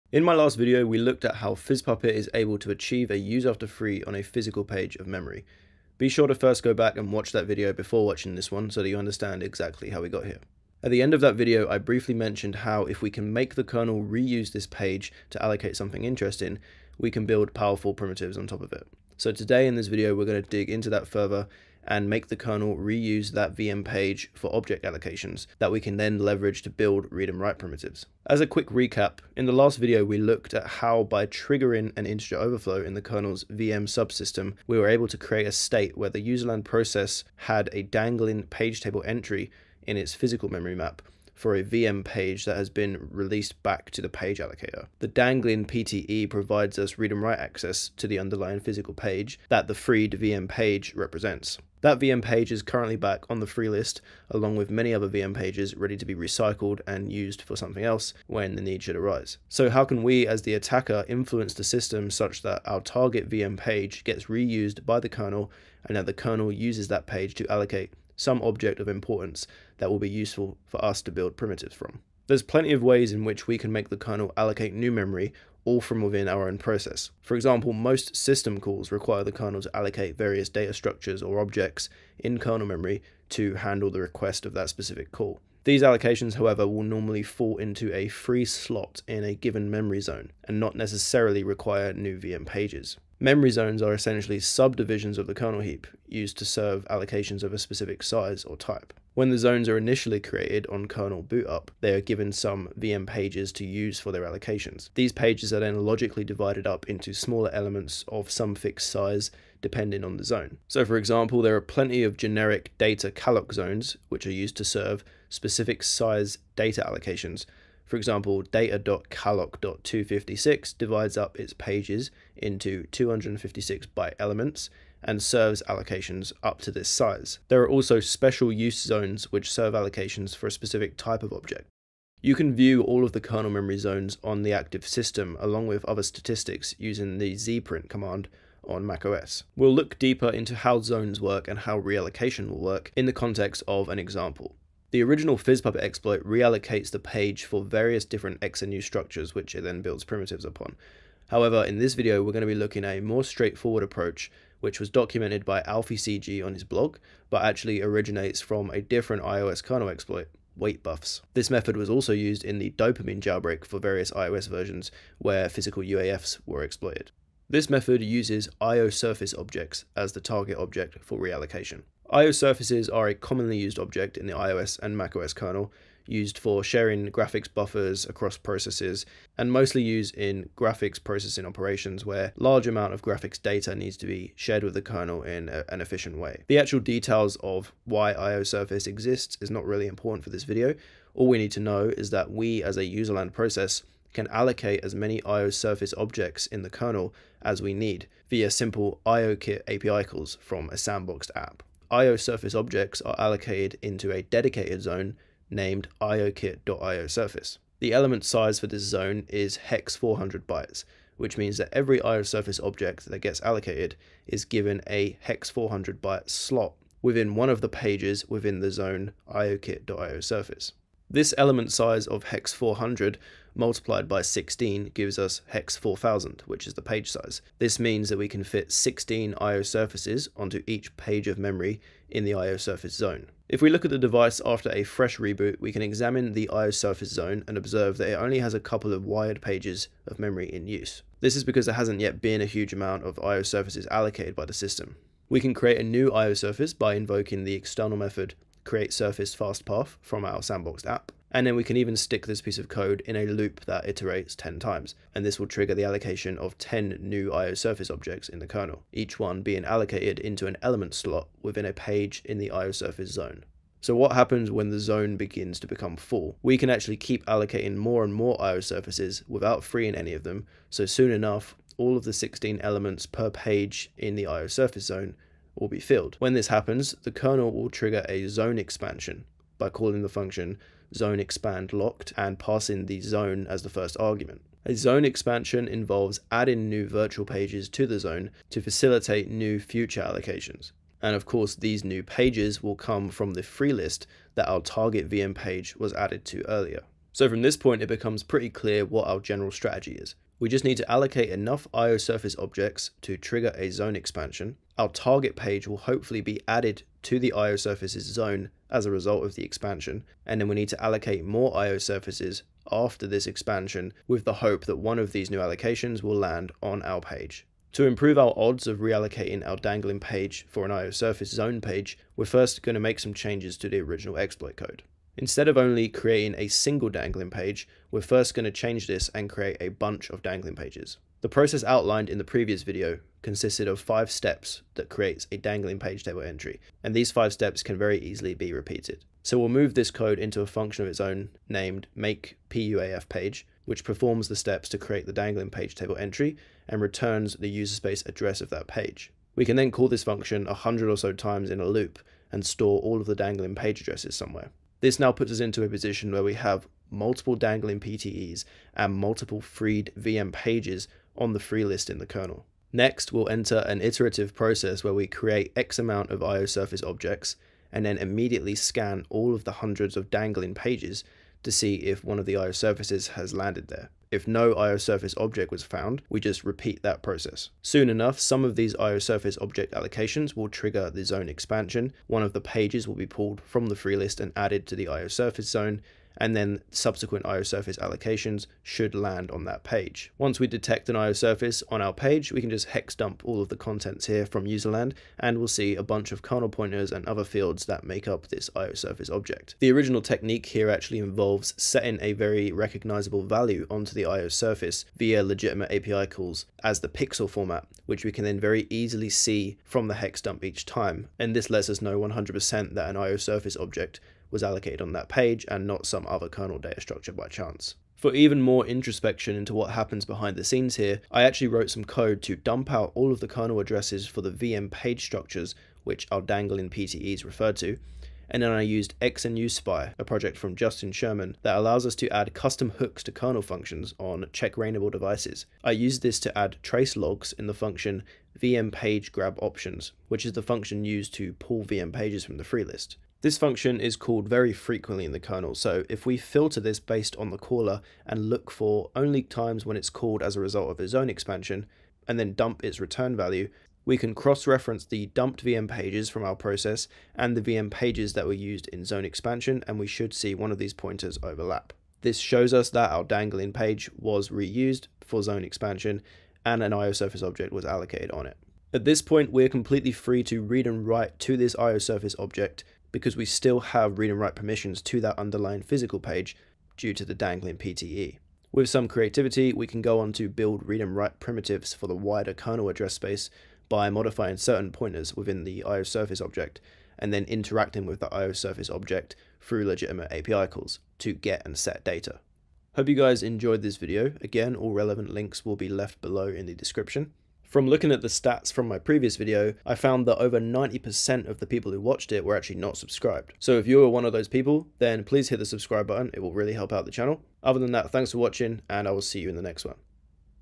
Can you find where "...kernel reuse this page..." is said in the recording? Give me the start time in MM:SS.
00:13.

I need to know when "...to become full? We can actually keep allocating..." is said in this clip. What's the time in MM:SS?
04:25.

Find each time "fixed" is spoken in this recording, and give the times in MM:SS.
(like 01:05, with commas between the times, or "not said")
01:48.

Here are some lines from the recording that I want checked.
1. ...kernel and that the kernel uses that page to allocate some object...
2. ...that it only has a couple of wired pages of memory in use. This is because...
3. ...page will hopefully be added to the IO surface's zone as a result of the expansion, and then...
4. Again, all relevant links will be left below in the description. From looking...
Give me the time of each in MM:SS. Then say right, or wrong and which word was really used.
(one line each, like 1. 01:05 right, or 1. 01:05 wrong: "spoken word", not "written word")
1. 01:05 right
2. 03:57 right
3. 05:05 right
4. 08:14 right.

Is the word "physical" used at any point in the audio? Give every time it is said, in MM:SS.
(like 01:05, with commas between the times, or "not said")
00:04, 00:40, 00:48, 02:45, 07:55.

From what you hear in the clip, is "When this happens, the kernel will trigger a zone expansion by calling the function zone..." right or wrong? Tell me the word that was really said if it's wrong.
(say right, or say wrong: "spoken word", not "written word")
right.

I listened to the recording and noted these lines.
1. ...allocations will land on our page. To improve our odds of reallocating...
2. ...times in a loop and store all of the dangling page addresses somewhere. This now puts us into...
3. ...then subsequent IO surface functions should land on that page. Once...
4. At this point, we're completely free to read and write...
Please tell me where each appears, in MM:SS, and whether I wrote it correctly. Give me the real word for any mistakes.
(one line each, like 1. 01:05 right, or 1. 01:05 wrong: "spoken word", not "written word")
1. 05:15 right
2. 05:51 right
3. 06:26 wrong: "allocations", not "functions"
4. 07:48 right.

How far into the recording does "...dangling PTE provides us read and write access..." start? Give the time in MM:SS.
00:45.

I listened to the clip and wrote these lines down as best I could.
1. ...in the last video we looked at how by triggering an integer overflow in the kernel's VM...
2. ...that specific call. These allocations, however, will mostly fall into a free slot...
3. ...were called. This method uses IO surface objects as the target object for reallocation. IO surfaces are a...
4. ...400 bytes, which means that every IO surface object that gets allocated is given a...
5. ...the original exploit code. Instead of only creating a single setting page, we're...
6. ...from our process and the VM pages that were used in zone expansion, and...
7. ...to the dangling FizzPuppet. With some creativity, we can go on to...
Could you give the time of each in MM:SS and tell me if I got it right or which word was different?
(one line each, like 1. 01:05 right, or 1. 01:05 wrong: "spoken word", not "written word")
1. 00:29 right
2. 01:24 wrong: "normally", not "mostly"
3. 02:46 wrong: "exploited", not "called"
4. 03:29 right
5. 05:23 wrong: "dangling", not "setting"
6. 07:36 right
7. 07:56 wrong: "PTE", not "FizzPuppet".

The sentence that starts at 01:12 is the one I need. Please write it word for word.
There's plenty of ways in which we can make the kernel allocate new memory all from within our own process.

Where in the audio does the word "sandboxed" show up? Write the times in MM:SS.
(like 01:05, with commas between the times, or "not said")
03:20, 04:10.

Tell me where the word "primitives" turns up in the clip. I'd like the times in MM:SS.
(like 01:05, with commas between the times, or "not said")
00:17, 00:27, 01:11, 02:30, 08:01.